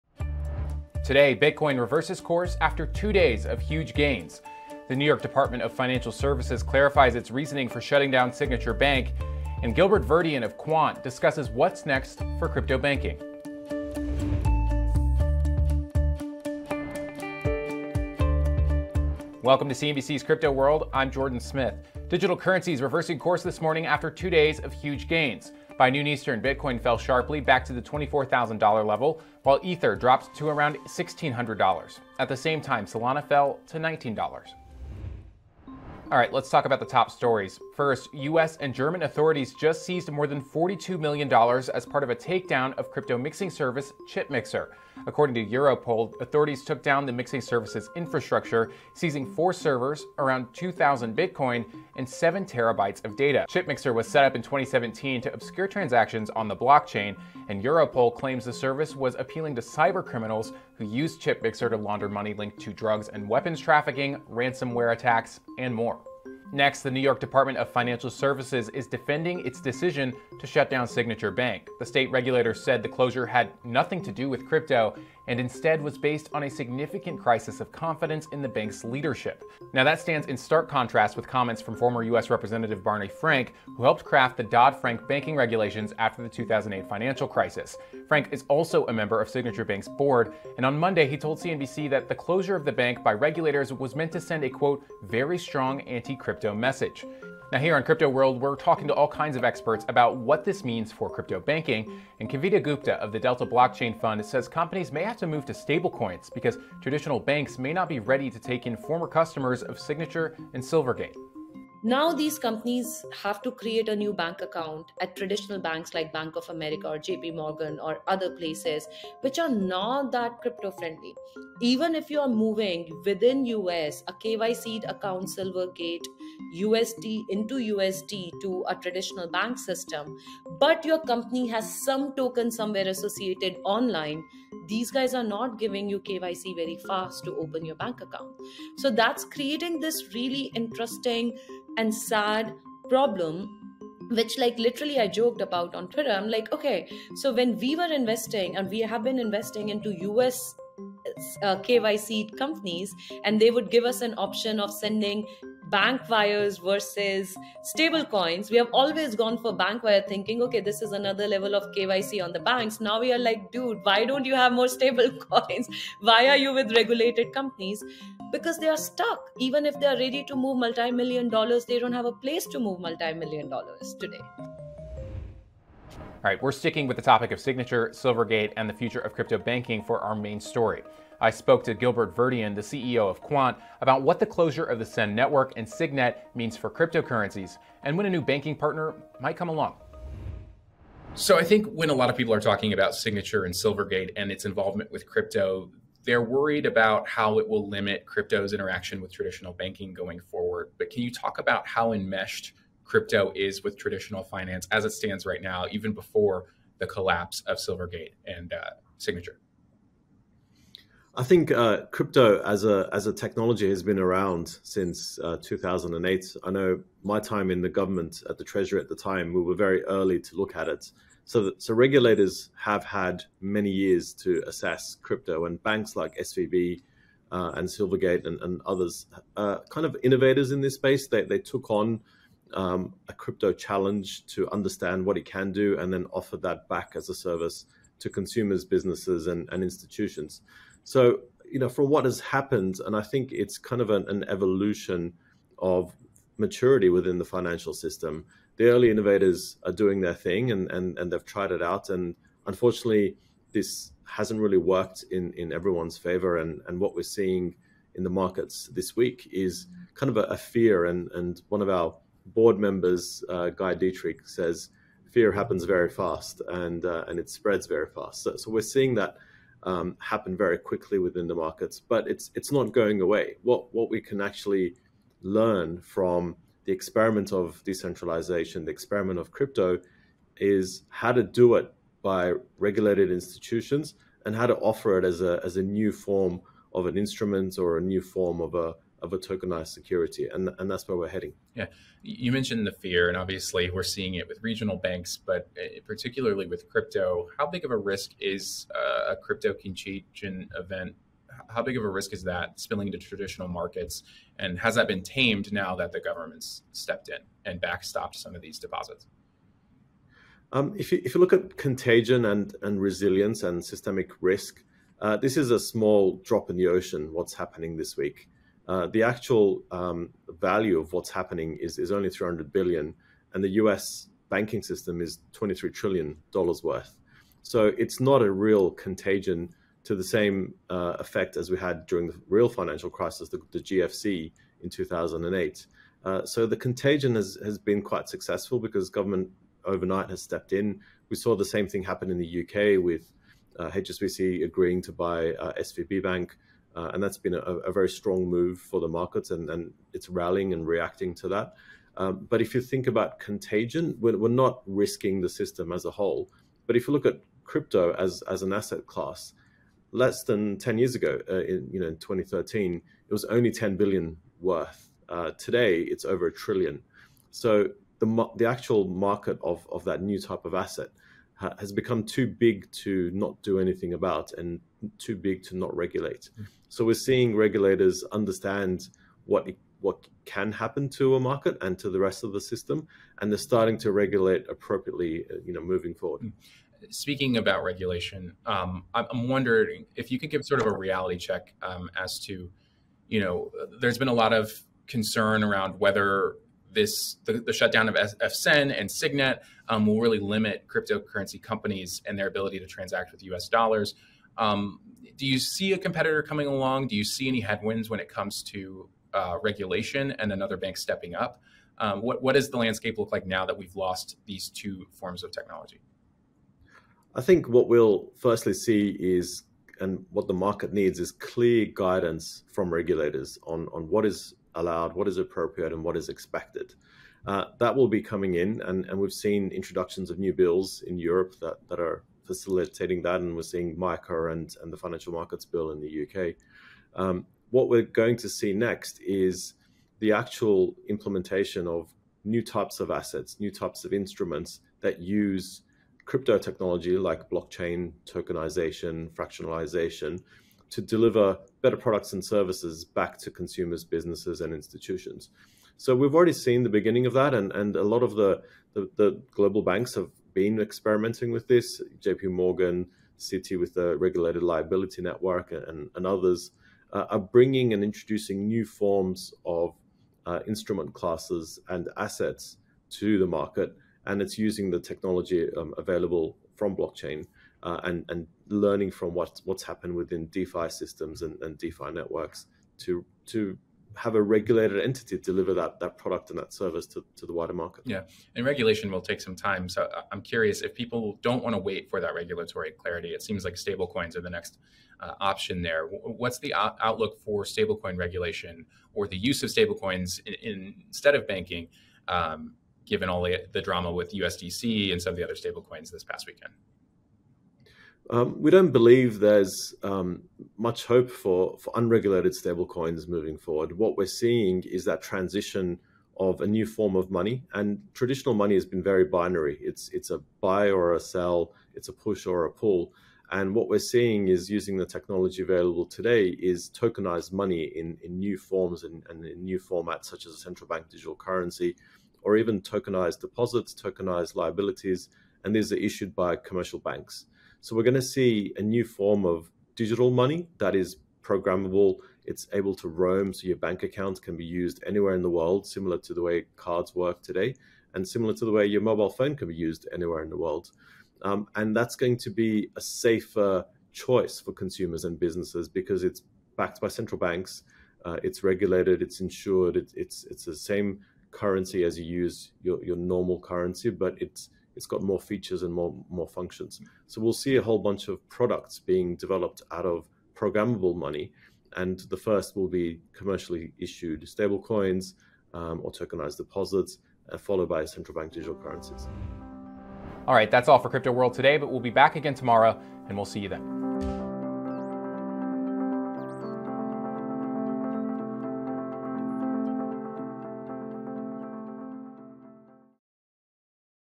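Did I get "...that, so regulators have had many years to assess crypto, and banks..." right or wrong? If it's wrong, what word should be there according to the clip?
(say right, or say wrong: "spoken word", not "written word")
right.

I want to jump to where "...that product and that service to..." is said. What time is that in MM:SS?
08:05.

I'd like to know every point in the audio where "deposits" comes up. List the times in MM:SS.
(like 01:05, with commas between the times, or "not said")
05:08, 08:53, 09:36.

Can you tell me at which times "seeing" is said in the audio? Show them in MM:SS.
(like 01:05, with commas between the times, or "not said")
04:17, 04:28, 04:53, 06:16, 07:13, 08:34, 08:43.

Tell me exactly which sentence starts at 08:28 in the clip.
Um, we don't believe there's um, much hope for, for unregulated stablecoins moving forward.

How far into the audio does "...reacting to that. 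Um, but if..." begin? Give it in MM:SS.
05:50.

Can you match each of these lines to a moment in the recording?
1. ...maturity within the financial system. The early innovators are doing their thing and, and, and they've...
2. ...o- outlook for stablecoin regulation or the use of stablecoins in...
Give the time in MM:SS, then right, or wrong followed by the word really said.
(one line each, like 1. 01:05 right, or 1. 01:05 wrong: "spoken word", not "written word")
1. 04:06 right
2. 08:16 right.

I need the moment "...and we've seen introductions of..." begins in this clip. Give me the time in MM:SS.
07:08.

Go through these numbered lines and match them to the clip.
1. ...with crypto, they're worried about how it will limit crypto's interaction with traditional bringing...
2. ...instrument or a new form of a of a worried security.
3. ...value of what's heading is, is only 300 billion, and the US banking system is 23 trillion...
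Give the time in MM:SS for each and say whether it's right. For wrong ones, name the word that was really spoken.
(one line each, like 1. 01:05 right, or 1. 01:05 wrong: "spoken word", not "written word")
1. 03:14 wrong: "banking", not "bringing"
2. 04:46 wrong: "tokenized", not "worried"
3. 05:20 wrong: "happening", not "heading".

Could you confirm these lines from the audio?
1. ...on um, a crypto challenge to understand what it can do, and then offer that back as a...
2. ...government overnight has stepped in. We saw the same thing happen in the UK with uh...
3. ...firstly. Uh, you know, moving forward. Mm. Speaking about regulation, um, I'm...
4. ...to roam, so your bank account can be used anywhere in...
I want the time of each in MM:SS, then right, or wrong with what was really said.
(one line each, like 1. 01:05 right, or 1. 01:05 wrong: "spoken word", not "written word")
1. 03:51 right
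2. 05:38 right
3. 06:24 wrong: "appropriately", not "firstly"
4. 09:02 right.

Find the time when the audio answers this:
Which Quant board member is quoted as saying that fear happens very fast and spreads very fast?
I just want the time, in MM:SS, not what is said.
04:23.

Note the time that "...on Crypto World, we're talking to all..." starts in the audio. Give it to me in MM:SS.
01:37.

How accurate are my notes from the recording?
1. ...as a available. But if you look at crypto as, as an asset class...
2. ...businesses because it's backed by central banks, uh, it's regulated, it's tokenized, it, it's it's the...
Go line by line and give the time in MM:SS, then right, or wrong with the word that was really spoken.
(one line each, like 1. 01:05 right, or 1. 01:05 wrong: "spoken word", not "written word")
1. 05:55 wrong: "whole", not "available"
2. 09:15 wrong: "insured", not "tokenized".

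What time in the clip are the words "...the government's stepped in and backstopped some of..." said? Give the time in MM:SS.
05:05.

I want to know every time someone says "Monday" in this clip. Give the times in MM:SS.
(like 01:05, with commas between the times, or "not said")
01:30.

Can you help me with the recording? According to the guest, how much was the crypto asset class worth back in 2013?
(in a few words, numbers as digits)
$10 billion.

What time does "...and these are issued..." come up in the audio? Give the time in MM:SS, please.
08:55.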